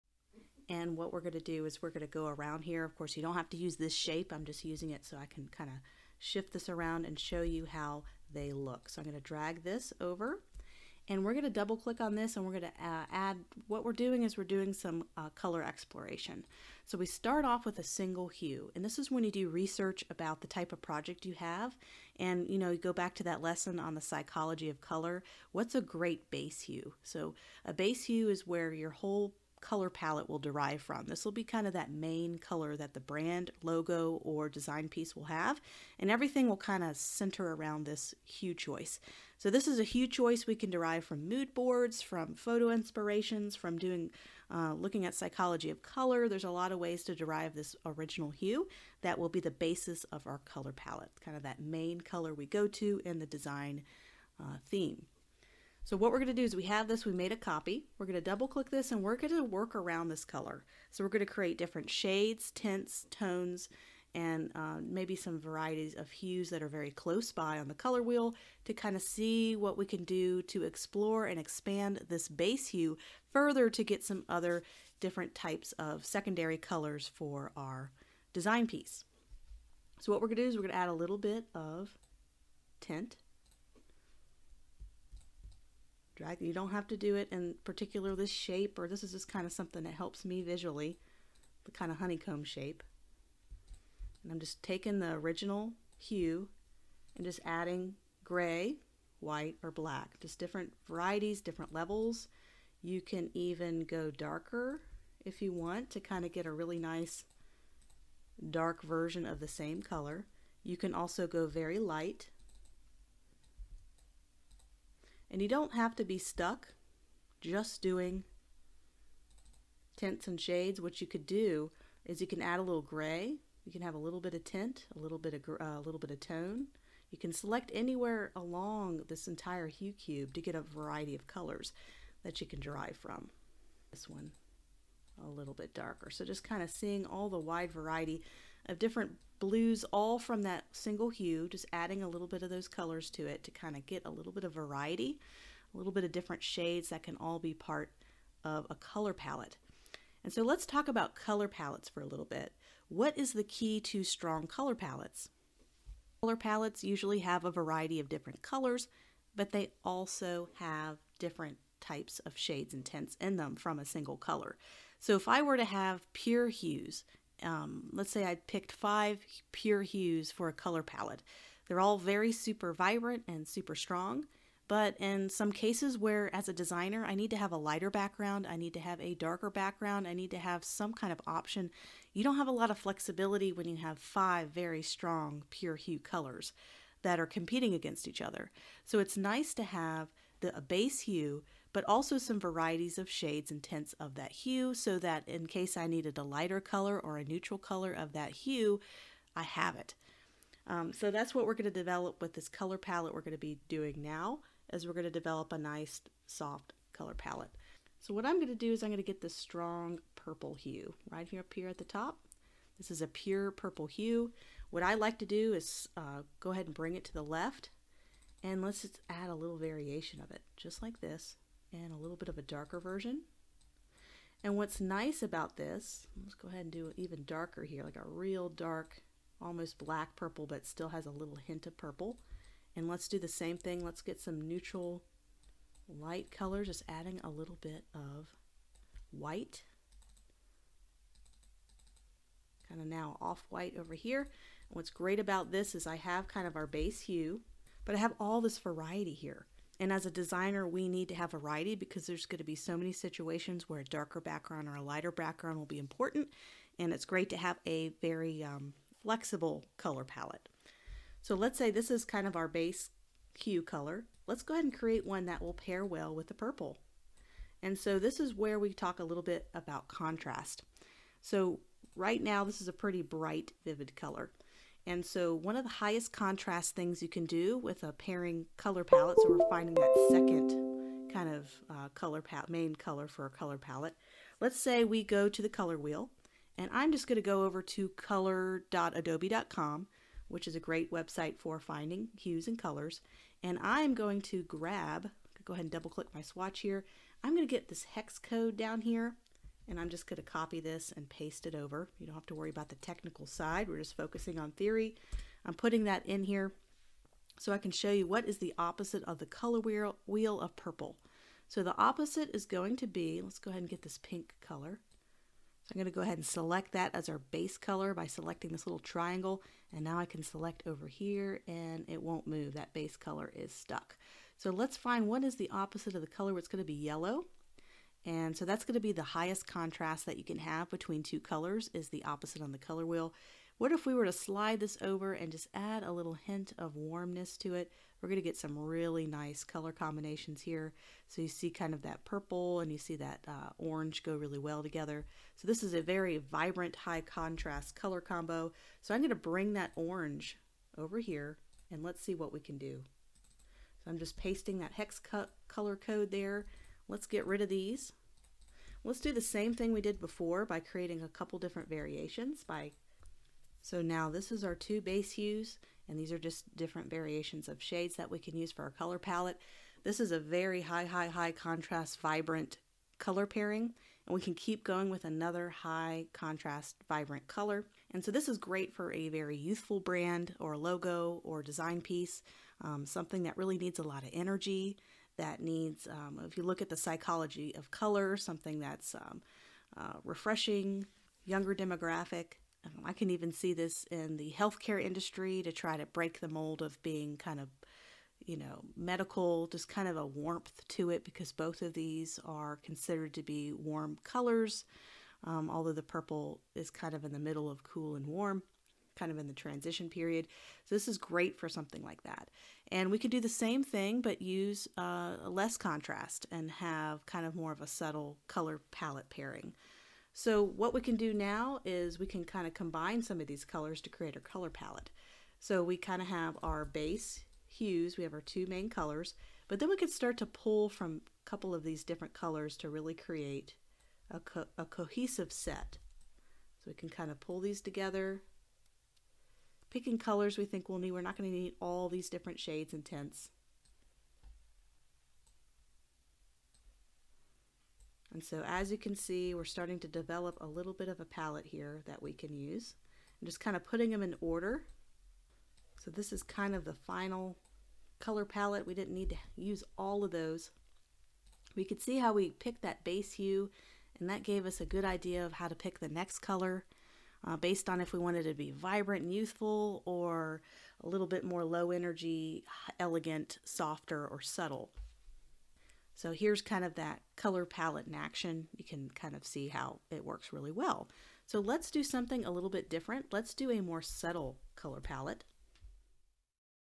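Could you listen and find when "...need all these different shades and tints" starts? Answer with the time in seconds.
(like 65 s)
441 s.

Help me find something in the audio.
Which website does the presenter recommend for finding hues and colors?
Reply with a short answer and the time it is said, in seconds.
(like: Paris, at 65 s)
color.adobe.com, at 287 s.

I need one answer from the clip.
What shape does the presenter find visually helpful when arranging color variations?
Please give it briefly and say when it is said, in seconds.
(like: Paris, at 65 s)
honeycomb shape, at 91 s.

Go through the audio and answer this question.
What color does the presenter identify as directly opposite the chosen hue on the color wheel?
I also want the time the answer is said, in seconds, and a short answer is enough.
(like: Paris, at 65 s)
Yellow, at 326 s.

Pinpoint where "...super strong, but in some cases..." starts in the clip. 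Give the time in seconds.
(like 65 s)
173 s.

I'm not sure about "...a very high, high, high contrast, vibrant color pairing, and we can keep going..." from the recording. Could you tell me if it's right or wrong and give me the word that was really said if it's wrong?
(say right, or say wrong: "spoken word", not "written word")
right.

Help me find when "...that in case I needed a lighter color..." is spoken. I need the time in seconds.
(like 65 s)
194 s.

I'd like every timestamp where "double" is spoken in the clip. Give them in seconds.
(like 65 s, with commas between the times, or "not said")
11 s, 58 s, 295 s.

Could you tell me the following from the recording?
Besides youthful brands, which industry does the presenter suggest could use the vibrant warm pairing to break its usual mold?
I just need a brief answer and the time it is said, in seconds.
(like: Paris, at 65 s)
healthcare, at 394 s.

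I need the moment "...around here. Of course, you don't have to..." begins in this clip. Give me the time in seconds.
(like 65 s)
2 s.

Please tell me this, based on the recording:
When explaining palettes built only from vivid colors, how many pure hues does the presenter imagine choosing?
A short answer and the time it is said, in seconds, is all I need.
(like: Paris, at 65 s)
5, at 168 s.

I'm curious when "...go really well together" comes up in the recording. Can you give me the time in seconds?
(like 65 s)
344 s.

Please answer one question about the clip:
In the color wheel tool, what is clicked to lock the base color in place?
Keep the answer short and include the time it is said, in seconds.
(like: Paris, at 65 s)
little triangle, at 318 s.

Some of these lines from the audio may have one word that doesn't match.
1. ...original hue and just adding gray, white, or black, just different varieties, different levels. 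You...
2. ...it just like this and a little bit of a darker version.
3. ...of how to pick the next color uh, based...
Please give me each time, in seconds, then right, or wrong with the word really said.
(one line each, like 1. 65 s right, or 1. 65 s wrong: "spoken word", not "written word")
1. 95 s right
2. 220 s right
3. 465 s right.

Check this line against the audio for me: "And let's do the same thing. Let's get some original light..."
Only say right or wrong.
wrong.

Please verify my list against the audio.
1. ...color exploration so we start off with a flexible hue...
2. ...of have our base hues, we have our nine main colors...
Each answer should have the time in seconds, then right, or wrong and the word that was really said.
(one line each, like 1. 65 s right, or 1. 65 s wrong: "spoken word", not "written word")
1. 15 s wrong: "single", not "flexible"
2. 426 s wrong: "two", not "nine".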